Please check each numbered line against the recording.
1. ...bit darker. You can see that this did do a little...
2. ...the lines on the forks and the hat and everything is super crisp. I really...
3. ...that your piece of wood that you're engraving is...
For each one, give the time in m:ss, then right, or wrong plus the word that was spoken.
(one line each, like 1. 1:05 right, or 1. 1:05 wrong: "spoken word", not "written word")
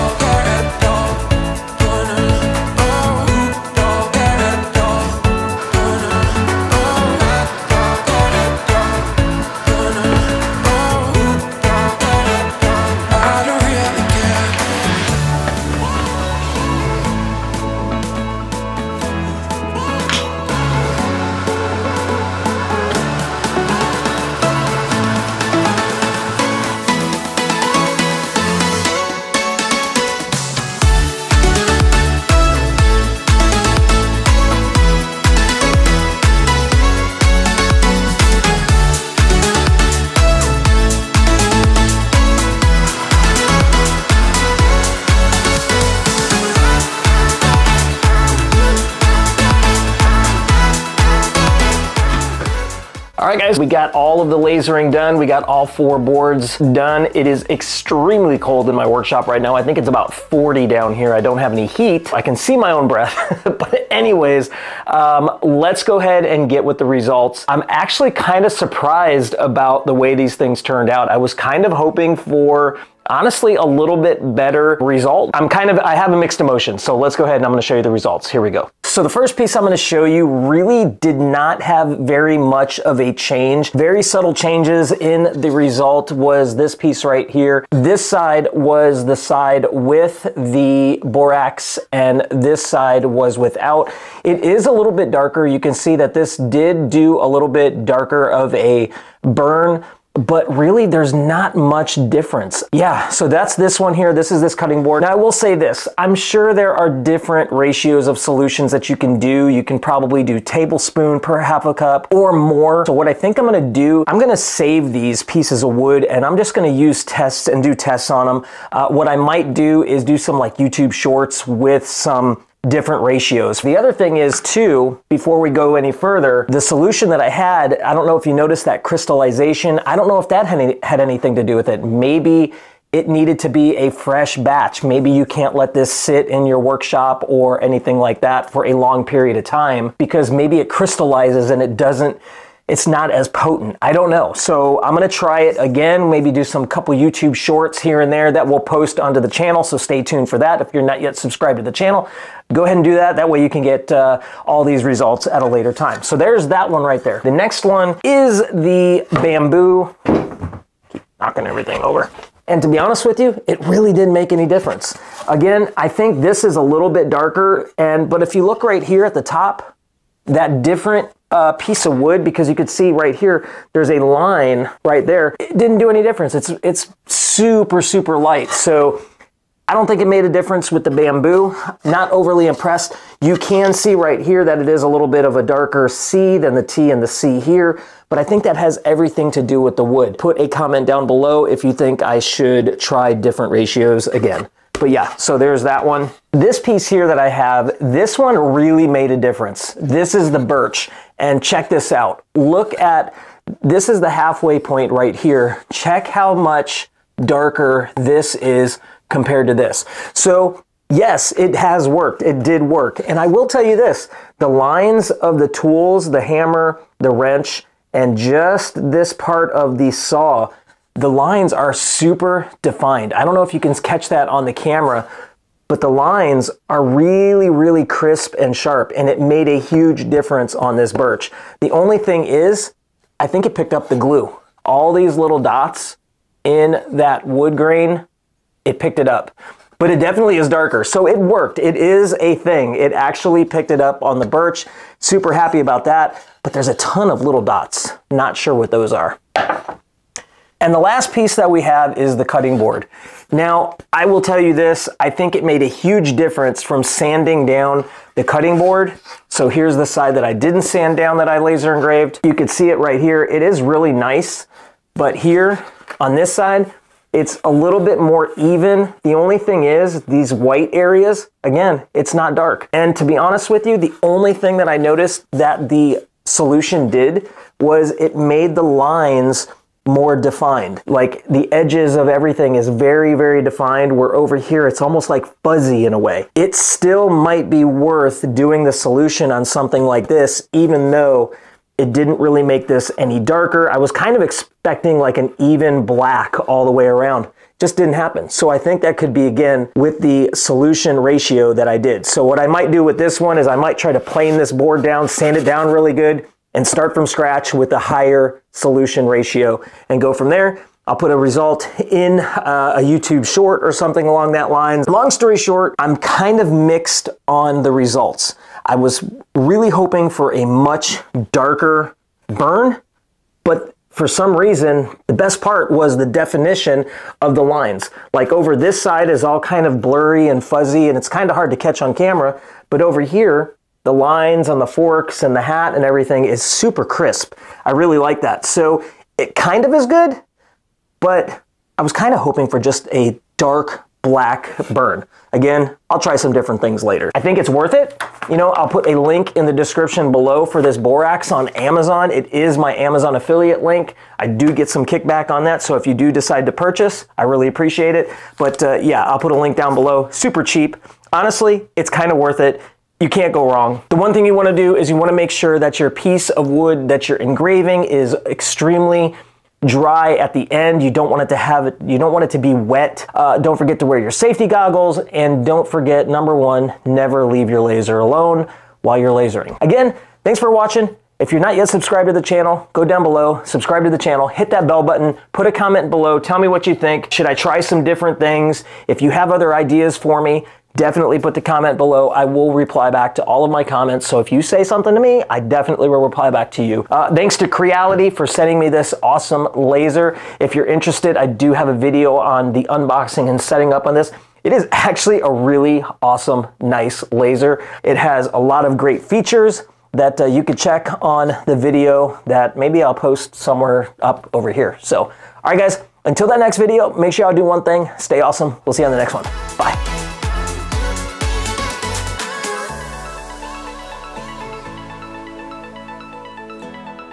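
1. 1:34 right
2. 5:33 right
3. 6:05 right.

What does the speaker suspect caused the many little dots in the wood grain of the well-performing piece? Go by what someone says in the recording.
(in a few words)
glue.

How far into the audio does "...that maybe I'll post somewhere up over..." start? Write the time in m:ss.
6:52.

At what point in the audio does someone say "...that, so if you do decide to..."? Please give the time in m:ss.
5:55.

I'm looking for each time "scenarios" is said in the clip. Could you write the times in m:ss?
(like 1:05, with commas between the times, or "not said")
not said.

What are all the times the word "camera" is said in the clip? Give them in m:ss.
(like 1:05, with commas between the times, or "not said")
3:44, 5:31.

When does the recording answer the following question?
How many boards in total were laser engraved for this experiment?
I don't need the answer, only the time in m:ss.
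0:55.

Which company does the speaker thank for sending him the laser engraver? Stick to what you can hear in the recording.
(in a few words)
Creality.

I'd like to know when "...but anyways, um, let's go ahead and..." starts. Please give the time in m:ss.
1:03.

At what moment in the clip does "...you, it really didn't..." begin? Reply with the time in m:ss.
2:43.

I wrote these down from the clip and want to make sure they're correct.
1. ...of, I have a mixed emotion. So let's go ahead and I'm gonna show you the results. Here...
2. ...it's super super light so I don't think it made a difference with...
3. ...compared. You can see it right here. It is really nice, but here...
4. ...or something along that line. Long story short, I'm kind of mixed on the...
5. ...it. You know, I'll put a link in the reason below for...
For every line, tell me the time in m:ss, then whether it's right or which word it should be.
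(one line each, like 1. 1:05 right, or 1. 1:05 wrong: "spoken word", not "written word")
1. 1:15 right
2. 2:56 right
3. 4:21 wrong: "engraved", not "compared"
4. 5:13 right
5. 5:47 wrong: "description", not "reason".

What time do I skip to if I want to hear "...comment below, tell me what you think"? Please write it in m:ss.
6:25.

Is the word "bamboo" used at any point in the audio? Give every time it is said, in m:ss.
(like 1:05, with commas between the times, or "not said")
2:39, 3:00.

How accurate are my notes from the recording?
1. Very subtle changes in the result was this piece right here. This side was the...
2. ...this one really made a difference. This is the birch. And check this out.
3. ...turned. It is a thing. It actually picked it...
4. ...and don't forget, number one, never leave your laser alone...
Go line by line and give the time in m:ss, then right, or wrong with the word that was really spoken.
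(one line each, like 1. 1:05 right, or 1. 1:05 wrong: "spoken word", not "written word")
1. 1:23 right
2. 3:17 right
3. 4:01 wrong: "worked", not "turned"
4. 6:14 right.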